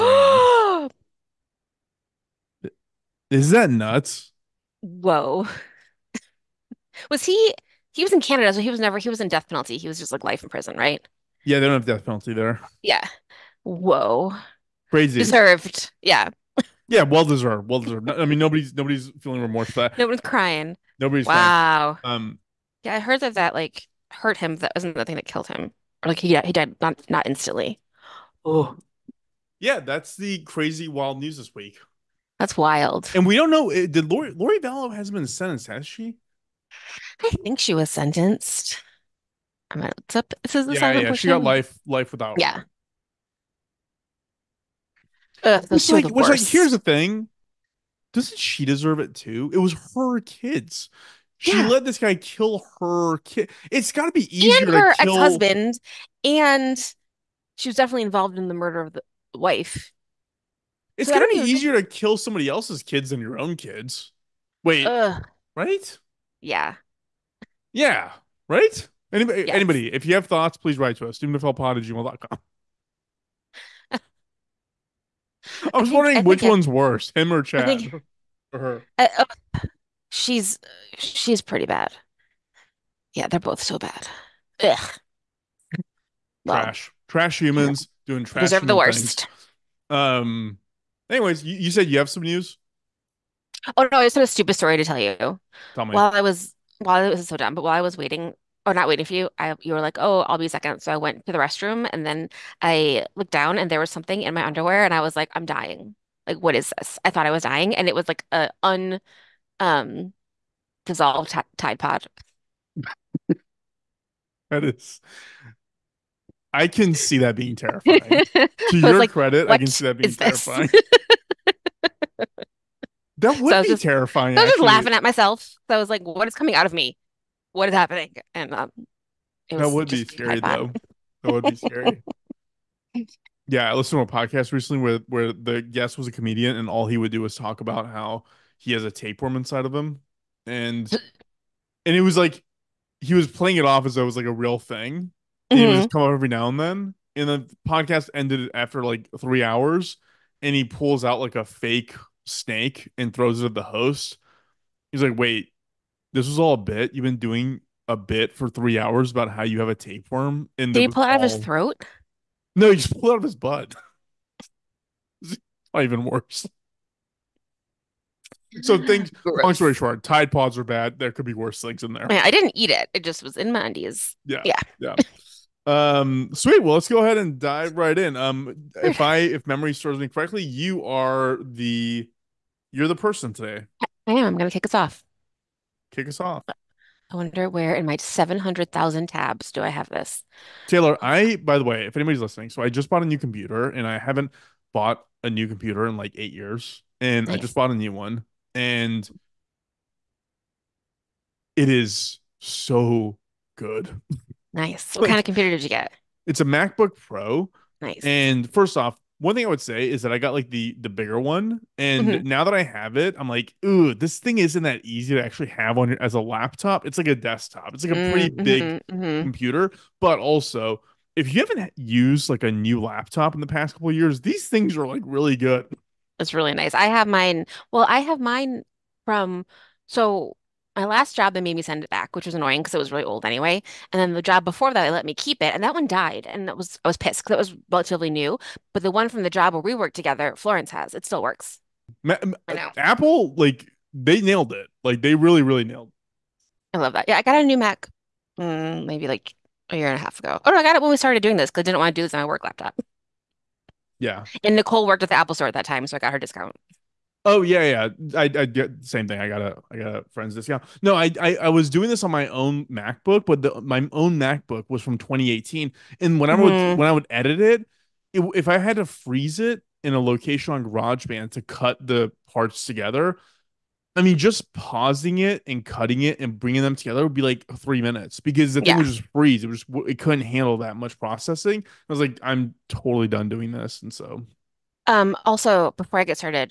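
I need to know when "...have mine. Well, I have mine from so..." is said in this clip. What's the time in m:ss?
3:46.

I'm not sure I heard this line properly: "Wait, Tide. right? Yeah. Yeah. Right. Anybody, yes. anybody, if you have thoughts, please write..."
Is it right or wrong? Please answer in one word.
wrong.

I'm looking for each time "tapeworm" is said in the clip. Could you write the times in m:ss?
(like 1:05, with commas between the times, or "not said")
2:18, 2:39.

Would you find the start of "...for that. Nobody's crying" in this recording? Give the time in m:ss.
0:19.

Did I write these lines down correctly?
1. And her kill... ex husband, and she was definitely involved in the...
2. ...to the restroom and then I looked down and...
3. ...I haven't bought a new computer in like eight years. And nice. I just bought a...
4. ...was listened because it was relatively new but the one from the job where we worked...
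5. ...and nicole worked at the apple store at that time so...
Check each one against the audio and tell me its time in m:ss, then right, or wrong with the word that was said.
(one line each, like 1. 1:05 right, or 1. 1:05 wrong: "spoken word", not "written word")
1. 0:54 right
2. 1:41 right
3. 3:13 right
4. 3:56 wrong: "pissed", not "listened"
5. 4:14 right.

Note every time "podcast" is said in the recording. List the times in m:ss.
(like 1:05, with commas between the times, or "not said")
2:14, 2:27.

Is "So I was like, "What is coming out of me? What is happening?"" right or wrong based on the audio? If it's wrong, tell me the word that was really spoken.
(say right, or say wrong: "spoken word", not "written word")
right.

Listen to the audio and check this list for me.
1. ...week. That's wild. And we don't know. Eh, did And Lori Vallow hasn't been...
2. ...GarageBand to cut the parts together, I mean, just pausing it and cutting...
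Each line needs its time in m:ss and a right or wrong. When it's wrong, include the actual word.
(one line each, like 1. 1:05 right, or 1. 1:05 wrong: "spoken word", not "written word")
1. 0:31 wrong: "Lori", not "And"
2. 4:30 right.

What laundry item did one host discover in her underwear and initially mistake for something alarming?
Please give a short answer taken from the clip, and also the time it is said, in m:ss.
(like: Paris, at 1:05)
Tide Pod, at 1:51.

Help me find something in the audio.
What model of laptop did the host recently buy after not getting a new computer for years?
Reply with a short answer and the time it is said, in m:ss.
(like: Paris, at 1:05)
MacBook Pro, at 3:26.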